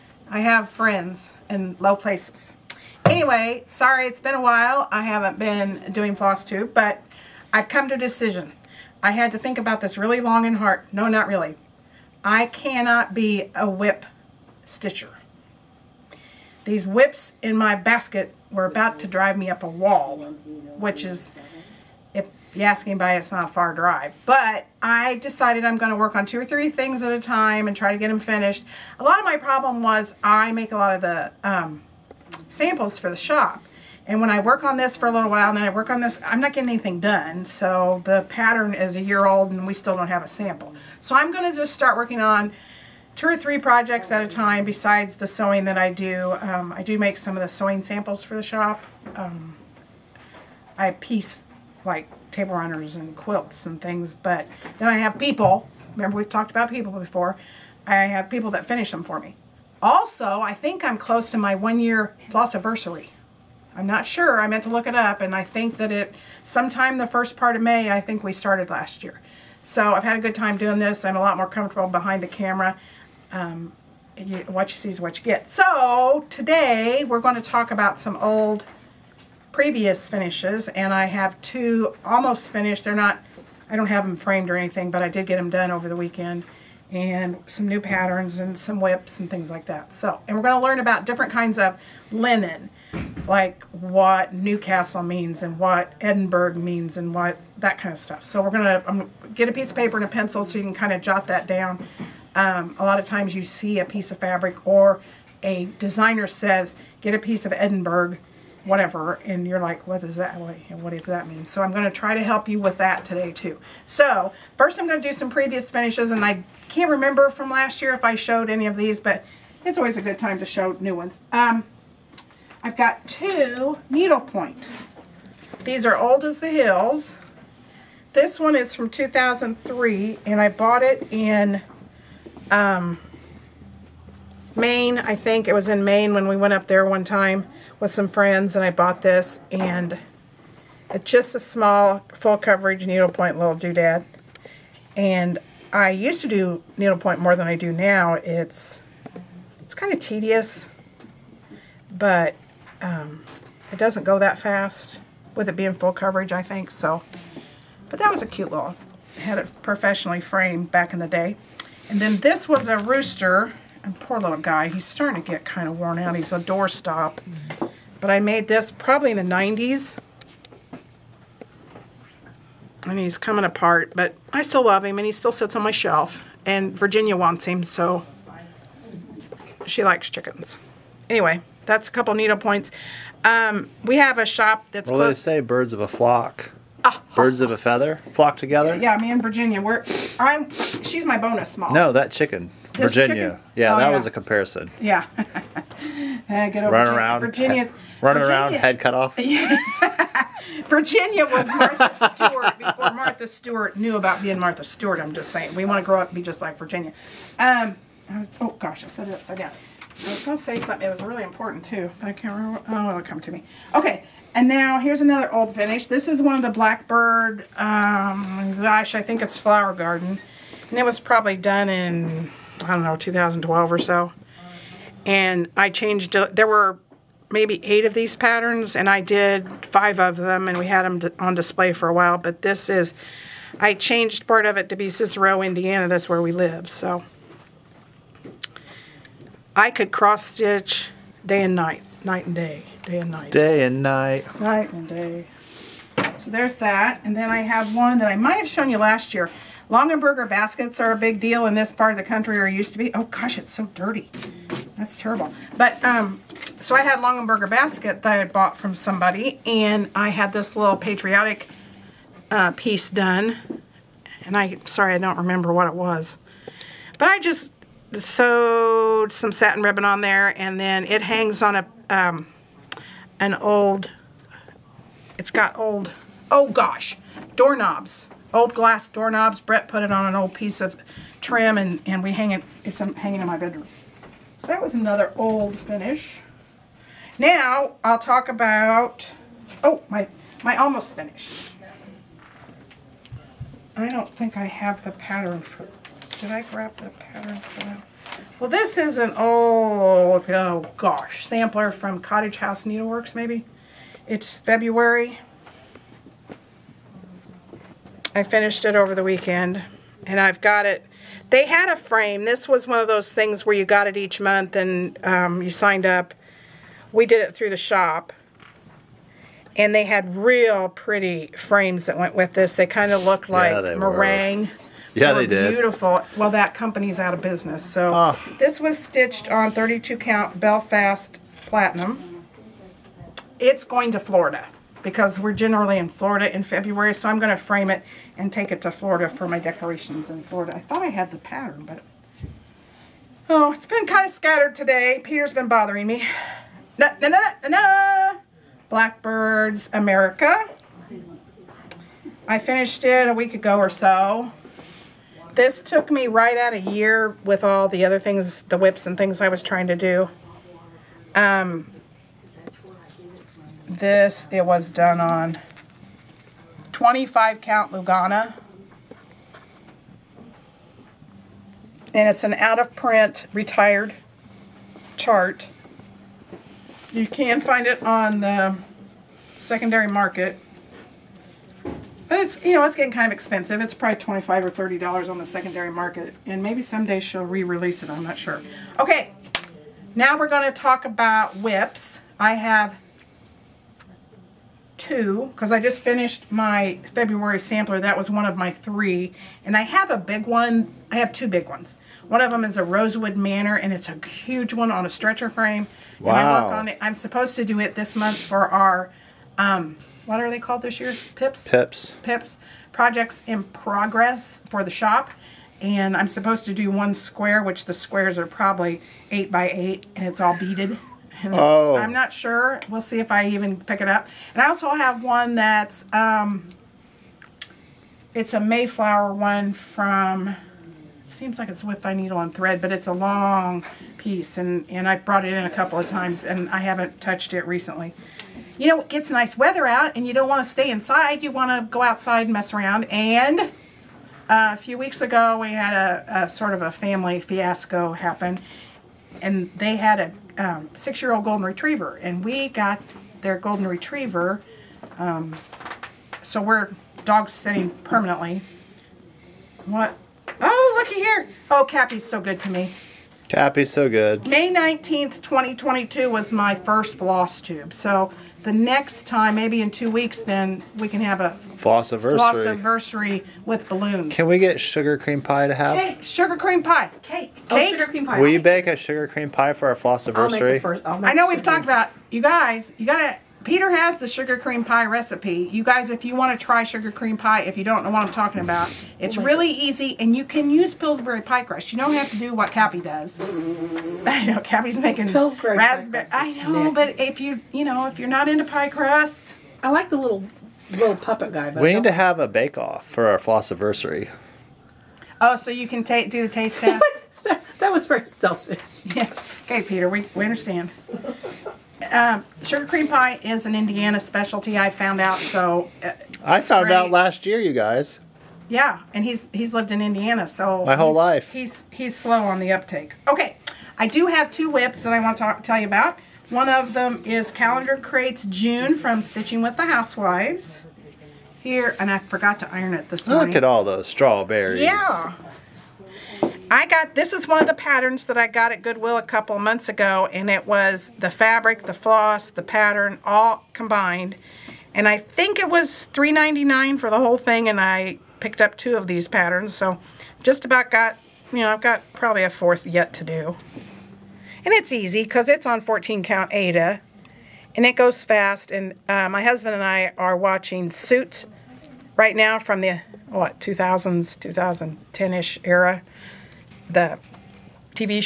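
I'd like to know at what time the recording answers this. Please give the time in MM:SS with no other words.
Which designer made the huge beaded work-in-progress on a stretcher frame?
06:42.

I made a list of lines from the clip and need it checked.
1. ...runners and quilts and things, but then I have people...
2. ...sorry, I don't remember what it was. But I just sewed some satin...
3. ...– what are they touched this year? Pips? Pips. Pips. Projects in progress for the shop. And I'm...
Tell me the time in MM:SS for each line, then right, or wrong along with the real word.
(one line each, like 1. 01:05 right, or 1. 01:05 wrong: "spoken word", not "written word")
1. 00:52 right
2. 04:24 right
3. 06:49 wrong: "called", not "touched".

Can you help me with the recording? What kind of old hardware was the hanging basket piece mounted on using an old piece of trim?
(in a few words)
Glass doorknobs.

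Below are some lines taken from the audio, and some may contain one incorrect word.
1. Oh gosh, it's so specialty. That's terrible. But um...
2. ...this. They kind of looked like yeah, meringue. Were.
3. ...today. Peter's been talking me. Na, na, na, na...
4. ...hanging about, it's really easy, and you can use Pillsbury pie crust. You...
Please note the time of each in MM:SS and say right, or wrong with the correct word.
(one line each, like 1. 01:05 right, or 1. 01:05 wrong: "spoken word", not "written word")
1. 04:12 wrong: "dirty", not "specialty"
2. 05:22 right
3. 05:44 wrong: "bothering", not "talking"
4. 08:08 wrong: "talking", not "hanging".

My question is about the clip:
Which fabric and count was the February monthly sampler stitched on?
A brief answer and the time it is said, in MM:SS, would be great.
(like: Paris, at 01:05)
32 count Belfast Platinum, at 05:29.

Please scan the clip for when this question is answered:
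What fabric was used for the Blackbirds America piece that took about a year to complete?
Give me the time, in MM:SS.
06:06.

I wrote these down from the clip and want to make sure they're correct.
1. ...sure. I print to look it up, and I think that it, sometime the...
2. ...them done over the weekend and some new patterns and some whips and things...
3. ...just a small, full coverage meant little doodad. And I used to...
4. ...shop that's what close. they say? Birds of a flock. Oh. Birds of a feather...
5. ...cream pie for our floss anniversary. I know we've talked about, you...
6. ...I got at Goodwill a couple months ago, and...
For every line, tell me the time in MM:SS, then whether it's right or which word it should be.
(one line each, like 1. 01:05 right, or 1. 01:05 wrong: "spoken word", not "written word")
1. 01:04 wrong: "meant", not "print"
2. 01:25 right
3. 02:21 wrong: "needlepoint", not "meant"
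4. 03:04 right
5. 07:59 right
6. 08:58 right.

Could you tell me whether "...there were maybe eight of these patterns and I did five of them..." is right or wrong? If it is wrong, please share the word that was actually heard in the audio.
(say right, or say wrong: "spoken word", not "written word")
right.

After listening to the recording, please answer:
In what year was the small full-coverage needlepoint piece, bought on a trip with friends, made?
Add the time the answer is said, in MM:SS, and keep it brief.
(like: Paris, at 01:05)
2003, at 02:08.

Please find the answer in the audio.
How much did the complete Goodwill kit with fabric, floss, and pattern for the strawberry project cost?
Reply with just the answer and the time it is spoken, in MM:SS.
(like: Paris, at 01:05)
$3.99, at 09:05.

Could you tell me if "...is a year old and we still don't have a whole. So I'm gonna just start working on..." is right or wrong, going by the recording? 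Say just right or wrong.
wrong.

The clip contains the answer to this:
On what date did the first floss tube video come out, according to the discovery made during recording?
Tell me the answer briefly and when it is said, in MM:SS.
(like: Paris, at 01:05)
May 19th, 2022, at 07:44.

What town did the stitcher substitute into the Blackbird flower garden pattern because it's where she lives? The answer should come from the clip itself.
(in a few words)
Cicero, Indiana.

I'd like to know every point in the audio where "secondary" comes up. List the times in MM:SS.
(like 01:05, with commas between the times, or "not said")
06:19, 06:25.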